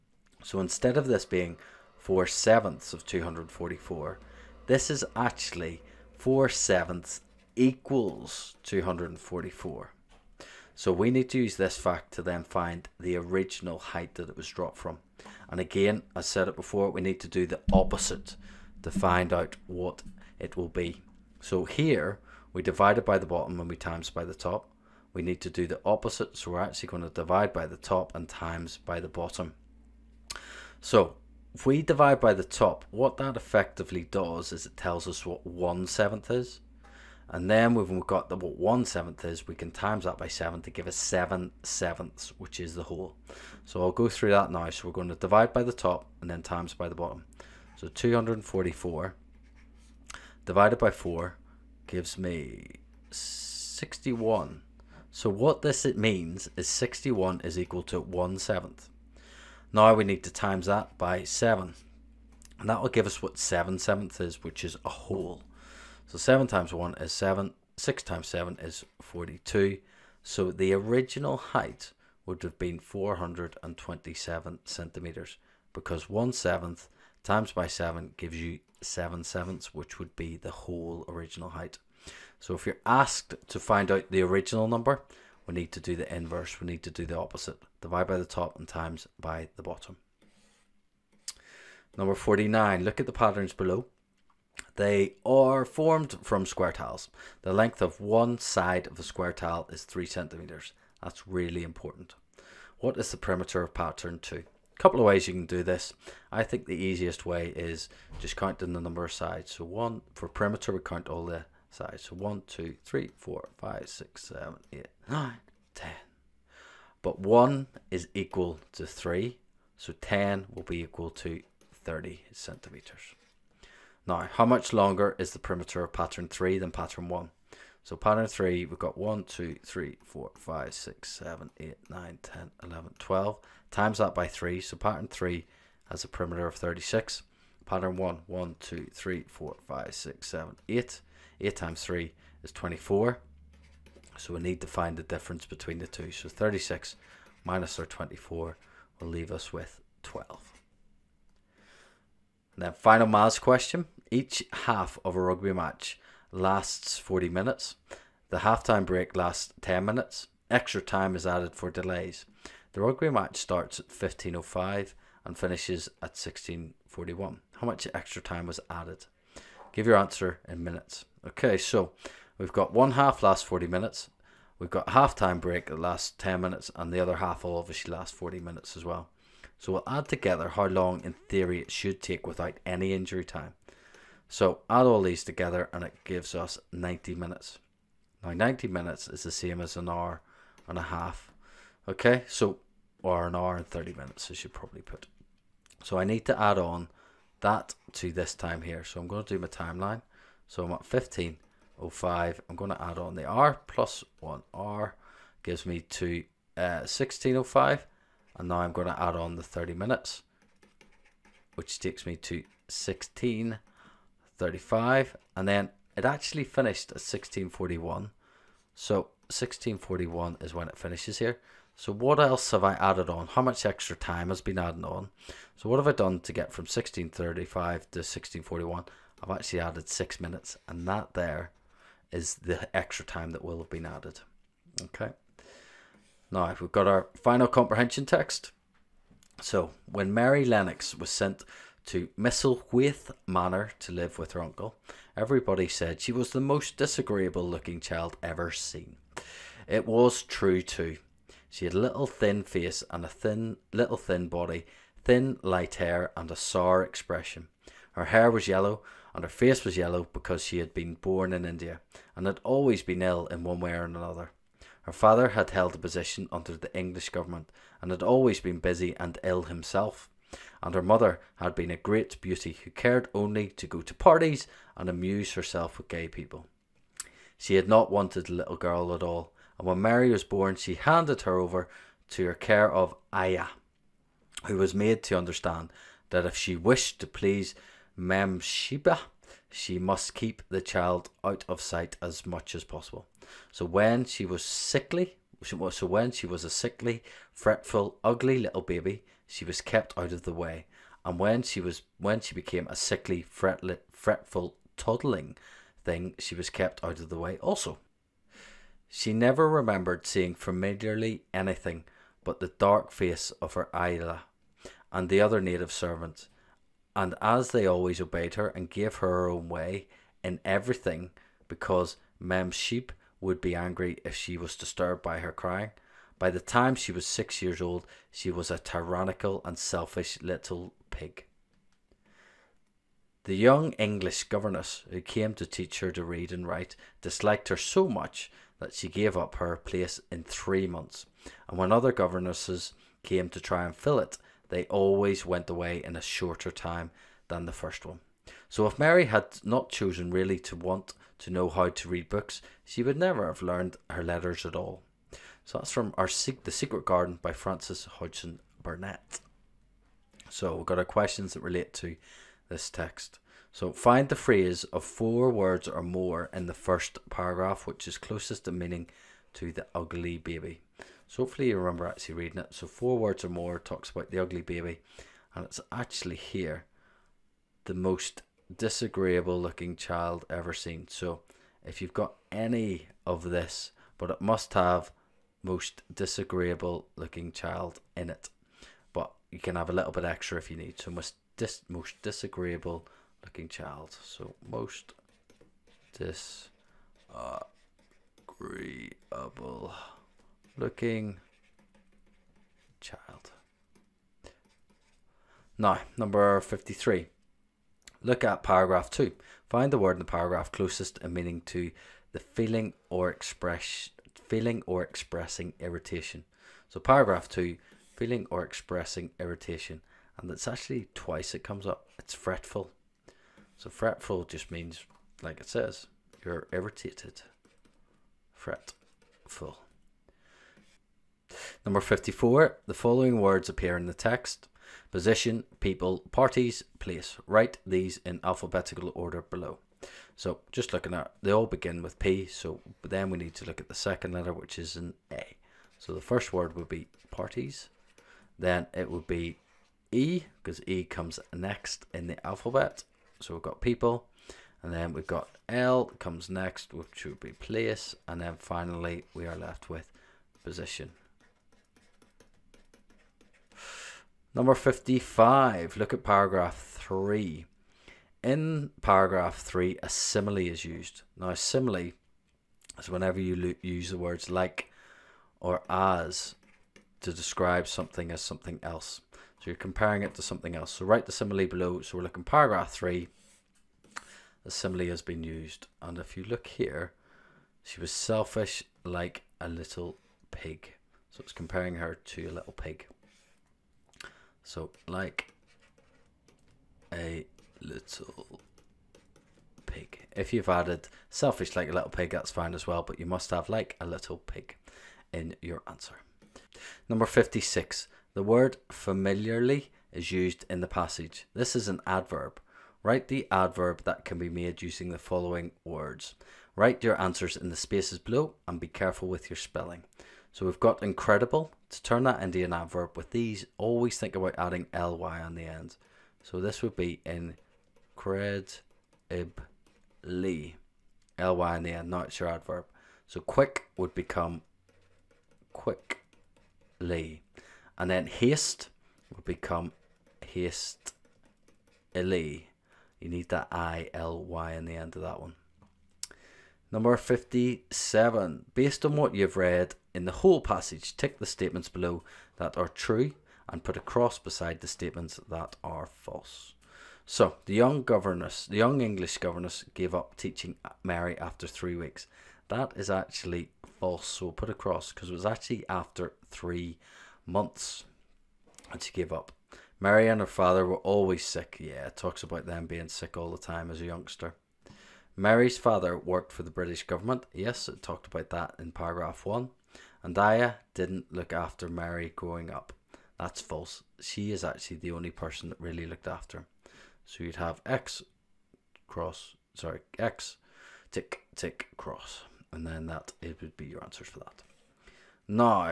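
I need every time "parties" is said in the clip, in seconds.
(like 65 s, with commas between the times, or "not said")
273 s, 436 s, 447 s.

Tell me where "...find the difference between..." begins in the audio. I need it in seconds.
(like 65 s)
144 s.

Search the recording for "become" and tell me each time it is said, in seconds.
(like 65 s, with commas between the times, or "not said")
533 s, 539 s.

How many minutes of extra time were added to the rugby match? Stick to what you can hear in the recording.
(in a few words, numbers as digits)
6 minutes.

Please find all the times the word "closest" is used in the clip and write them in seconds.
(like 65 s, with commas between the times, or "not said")
367 s, 410 s.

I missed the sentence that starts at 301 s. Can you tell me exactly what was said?
And when she was when she became a sickly, fretful, toddling thing, she was kept out of the way also.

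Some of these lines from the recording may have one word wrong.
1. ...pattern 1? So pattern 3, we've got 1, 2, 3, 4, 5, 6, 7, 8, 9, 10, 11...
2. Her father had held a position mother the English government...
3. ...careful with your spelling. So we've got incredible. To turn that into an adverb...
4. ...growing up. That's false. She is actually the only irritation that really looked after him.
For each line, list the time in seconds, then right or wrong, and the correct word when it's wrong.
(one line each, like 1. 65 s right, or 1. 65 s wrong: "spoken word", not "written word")
1. 126 s right
2. 264 s wrong: "under", not "mother"
3. 518 s right
4. 582 s wrong: "person", not "irritation".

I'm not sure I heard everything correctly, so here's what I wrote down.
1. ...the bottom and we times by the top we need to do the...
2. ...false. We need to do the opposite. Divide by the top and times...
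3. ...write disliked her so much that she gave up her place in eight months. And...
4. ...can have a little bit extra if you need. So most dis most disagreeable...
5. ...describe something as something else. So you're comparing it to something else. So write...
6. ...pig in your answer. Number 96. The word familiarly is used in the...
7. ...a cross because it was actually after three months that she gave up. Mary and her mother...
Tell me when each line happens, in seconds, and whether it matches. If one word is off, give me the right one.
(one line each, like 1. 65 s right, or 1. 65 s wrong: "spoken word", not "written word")
1. 23 s right
2. 86 s wrong: "inverse", not "false"
3. 336 s wrong: "three", not "eight"
4. 389 s right
5. 477 s right
6. 504 s wrong: "56", not "96"
7. 564 s wrong: "father", not "mother".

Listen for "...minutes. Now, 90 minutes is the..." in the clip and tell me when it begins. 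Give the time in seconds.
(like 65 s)
187 s.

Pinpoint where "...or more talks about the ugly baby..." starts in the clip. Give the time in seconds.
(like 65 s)
373 s.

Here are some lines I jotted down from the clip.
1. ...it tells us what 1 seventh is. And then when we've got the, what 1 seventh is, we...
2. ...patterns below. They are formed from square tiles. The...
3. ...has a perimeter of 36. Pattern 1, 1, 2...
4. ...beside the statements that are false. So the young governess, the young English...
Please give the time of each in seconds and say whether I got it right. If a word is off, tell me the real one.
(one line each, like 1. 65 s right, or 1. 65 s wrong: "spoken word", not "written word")
1. 34 s right
2. 93 s right
3. 135 s right
4. 554 s right.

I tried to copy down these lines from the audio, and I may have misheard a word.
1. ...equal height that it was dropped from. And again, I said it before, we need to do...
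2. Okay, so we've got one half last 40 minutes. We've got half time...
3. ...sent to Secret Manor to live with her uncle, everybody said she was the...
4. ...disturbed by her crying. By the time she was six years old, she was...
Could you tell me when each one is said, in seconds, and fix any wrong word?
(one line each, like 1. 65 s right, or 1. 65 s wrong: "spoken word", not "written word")
1. 13 s wrong: "original", not "equal"
2. 171 s right
3. 241 s wrong: "Misselthwaite", not "Secret"
4. 324 s right.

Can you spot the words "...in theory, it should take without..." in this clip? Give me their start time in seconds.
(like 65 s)
181 s.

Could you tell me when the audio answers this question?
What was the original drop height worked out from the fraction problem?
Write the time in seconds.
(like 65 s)
72 s.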